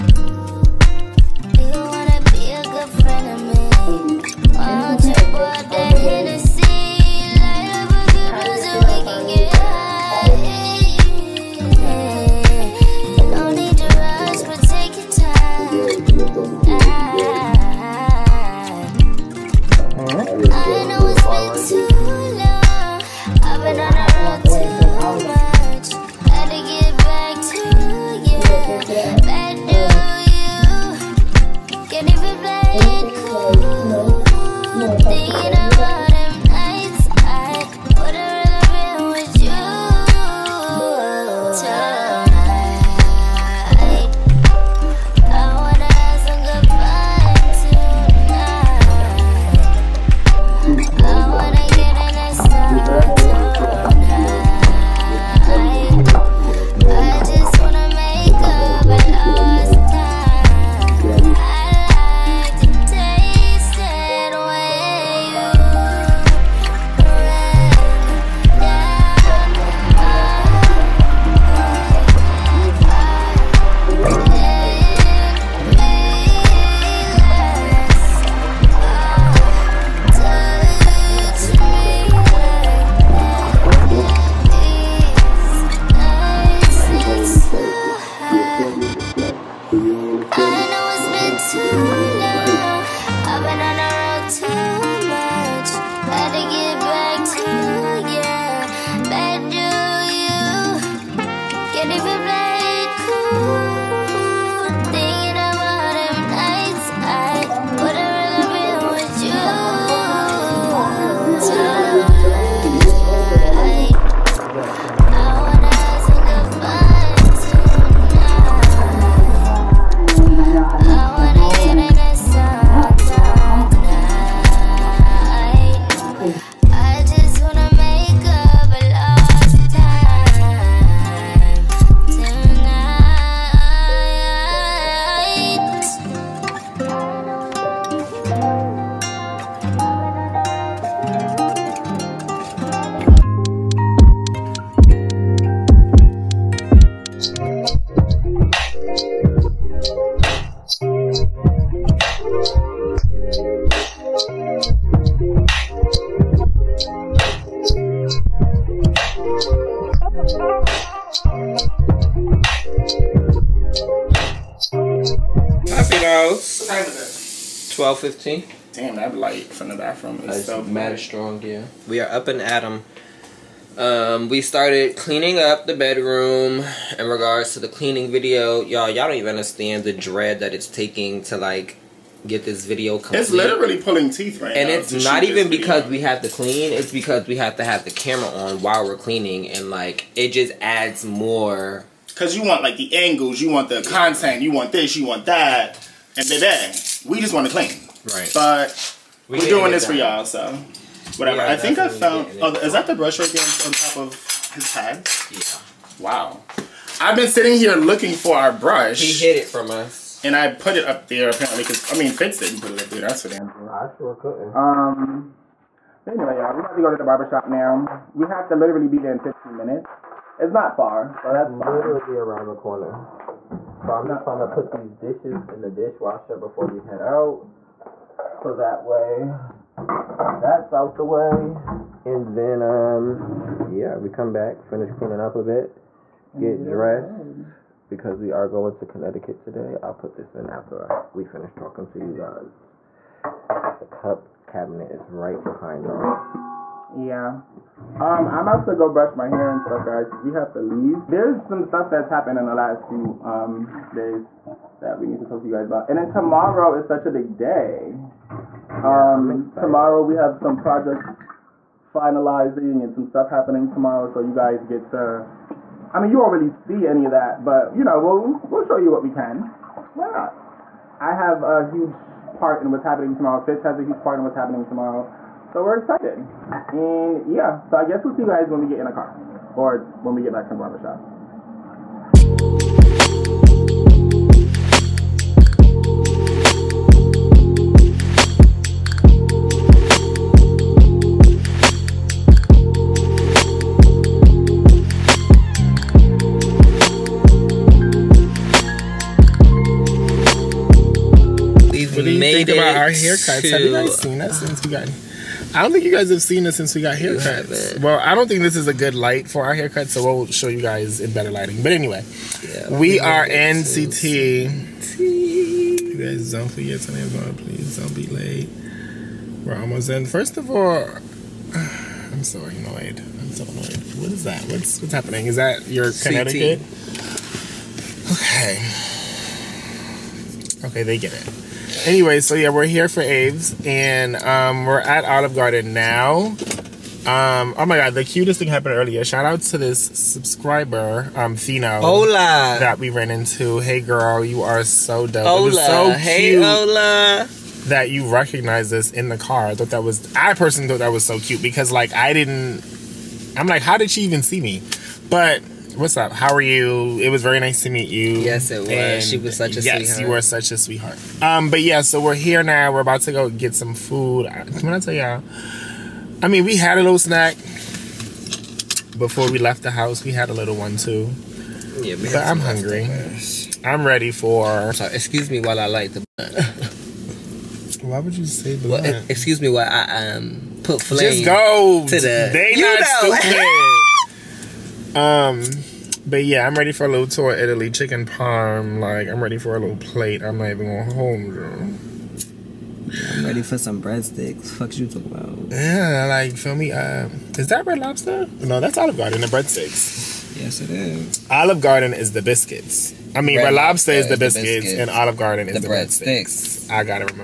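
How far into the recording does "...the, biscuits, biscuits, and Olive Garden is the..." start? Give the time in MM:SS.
06:44.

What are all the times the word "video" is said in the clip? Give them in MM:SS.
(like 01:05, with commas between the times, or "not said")
02:58, 03:02.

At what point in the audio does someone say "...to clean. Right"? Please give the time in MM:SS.
03:17.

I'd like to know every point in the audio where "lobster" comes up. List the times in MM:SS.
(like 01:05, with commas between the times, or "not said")
06:37, 06:43.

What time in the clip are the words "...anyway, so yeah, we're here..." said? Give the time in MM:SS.
05:31.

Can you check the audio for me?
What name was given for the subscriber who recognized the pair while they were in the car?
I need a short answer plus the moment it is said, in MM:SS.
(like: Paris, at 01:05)
Fino, at 05:41.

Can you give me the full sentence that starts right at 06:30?
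I'm not even going home, girl.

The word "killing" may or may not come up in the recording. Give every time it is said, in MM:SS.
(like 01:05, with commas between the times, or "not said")
not said.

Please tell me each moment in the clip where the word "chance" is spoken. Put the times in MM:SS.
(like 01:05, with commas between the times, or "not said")
not said.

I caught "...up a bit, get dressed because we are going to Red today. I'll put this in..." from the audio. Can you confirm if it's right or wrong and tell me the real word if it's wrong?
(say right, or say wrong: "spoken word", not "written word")
wrong: "Connecticut", not "Red".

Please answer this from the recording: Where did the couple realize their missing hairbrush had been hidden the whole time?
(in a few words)
On top of his head.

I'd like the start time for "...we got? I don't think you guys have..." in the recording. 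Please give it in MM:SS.
05:04.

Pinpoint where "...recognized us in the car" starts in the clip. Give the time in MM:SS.
05:48.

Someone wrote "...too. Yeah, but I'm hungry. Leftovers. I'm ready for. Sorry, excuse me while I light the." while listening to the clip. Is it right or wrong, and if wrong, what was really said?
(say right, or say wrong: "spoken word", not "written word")
right.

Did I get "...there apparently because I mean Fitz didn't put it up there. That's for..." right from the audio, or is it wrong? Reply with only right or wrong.
right.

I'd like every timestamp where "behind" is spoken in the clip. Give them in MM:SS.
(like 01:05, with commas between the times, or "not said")
04:05.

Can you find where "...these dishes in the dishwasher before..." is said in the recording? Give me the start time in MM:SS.
03:44.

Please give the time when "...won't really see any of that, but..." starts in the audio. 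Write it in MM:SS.
04:26.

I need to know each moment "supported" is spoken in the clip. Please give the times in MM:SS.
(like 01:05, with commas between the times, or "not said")
not said.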